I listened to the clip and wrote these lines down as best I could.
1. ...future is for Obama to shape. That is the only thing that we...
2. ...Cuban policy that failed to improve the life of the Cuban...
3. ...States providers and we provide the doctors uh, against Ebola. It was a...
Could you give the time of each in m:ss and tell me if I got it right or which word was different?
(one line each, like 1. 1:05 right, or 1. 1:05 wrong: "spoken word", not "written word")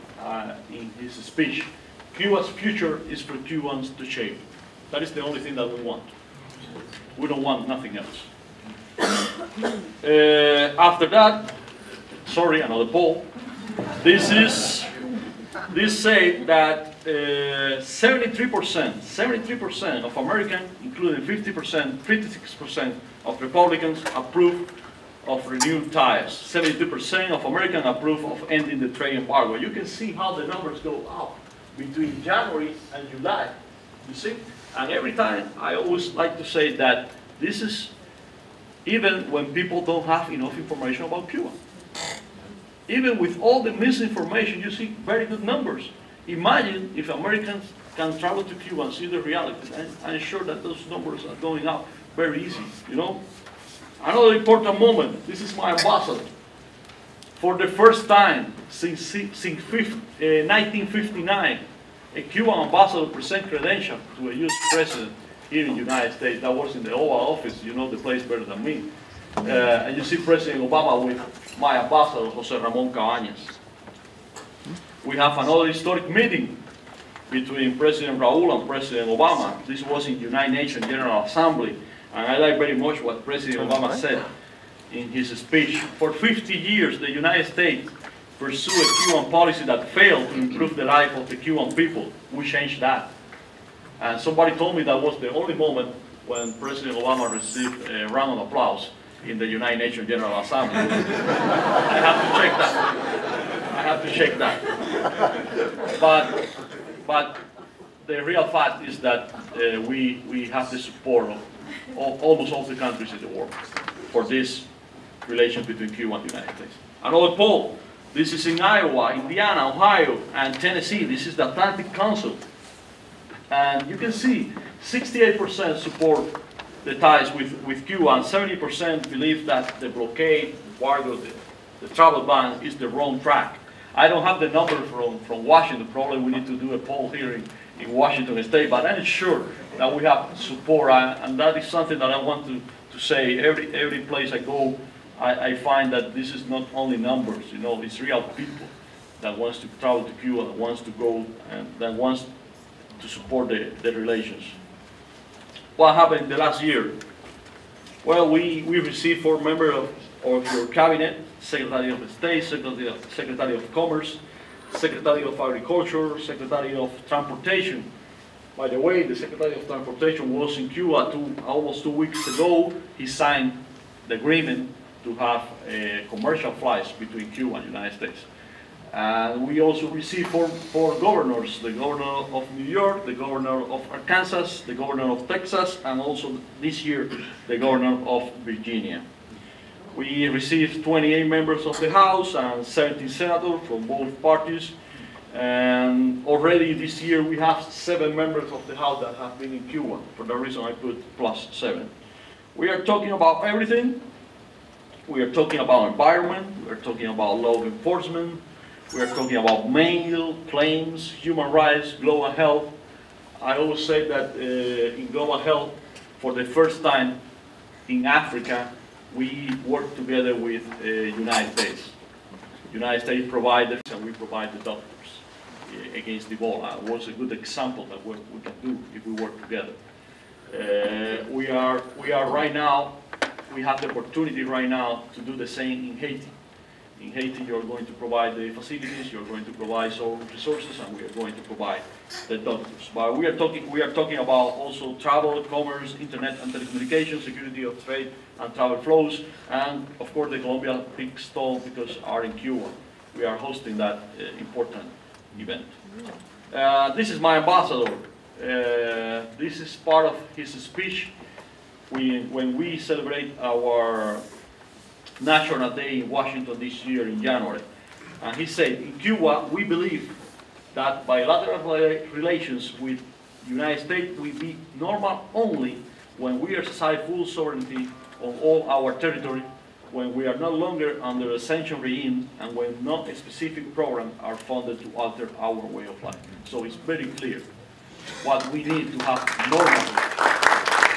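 1. 0:02 wrong: "Cubans", not "Obama"
2. 1:29 right
3. 3:43 right.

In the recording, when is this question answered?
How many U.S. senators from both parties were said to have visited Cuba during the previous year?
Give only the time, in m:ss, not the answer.
3:12.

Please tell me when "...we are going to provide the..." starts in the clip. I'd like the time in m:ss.
4:00.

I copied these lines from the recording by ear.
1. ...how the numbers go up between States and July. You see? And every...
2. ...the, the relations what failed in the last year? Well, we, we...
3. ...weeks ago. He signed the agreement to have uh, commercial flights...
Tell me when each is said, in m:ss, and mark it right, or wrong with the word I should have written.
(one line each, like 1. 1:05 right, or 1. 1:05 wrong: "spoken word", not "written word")
1. 0:30 wrong: "January", not "States"
2. 2:33 wrong: "happened", not "failed"
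3. 2:51 right.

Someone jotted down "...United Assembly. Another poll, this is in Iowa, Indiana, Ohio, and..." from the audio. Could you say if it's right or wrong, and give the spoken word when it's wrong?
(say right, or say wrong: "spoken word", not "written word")
wrong: "States", not "Assembly".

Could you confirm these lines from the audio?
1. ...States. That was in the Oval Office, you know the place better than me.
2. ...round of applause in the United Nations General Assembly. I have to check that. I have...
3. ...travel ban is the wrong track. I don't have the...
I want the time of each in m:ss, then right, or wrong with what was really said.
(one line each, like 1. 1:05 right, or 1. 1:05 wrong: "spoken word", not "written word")
1. 1:06 right
2. 1:38 right
3. 2:11 right.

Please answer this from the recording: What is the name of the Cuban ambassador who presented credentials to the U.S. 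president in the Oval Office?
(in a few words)
Jose Ramon Cabañas.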